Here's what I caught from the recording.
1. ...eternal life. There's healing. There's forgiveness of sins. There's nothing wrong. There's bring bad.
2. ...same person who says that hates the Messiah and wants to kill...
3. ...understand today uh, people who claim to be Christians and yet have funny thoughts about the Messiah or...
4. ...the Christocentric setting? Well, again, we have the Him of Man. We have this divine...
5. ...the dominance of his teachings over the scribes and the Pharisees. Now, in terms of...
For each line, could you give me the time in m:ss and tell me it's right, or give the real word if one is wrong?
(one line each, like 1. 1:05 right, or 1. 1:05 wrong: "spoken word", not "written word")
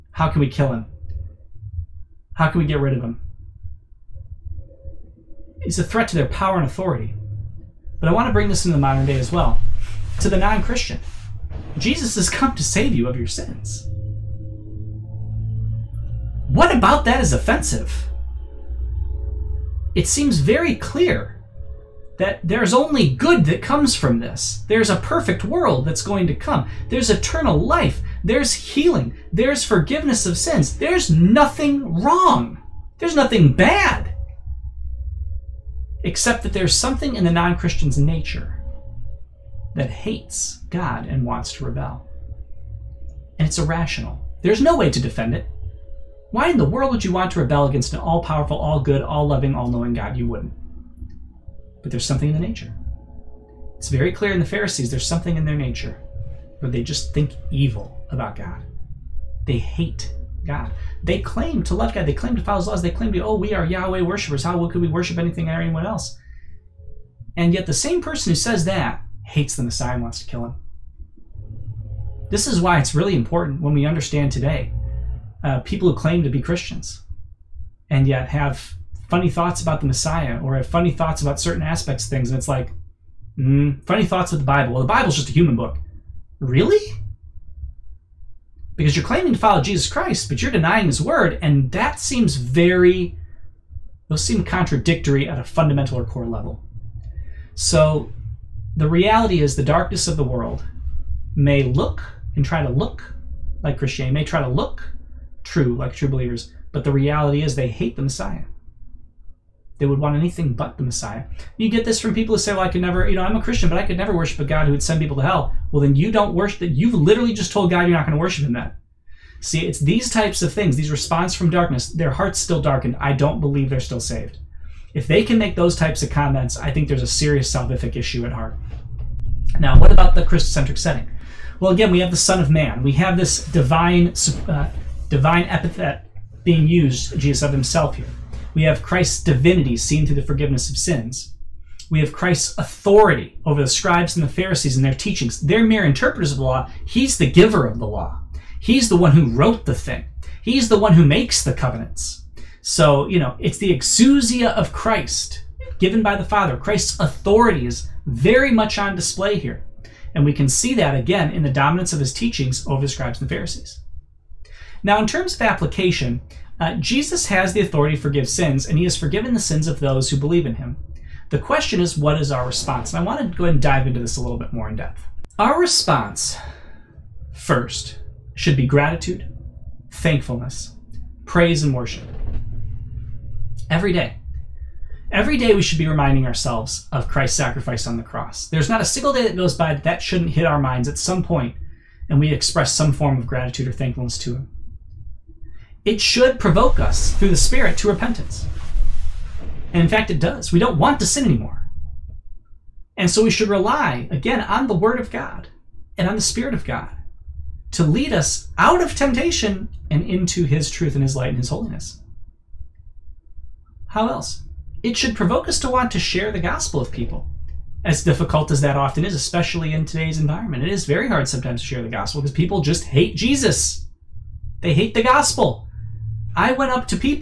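1. 0:27 wrong: "nothing", not "bring"
2. 1:07 right
3. 1:13 right
4. 2:10 wrong: "Son", not "Him"
5. 2:41 right.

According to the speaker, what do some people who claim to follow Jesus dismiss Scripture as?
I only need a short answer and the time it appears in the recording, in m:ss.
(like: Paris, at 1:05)
just a human book, at 1:25.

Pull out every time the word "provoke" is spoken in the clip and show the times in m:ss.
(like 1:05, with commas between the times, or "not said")
3:16, 3:35.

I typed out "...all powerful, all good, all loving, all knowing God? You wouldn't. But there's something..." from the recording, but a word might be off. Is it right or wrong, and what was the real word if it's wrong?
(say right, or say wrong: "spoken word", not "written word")
right.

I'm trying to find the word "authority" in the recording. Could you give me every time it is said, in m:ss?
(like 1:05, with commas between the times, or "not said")
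0:06, 2:22, 2:36, 2:47.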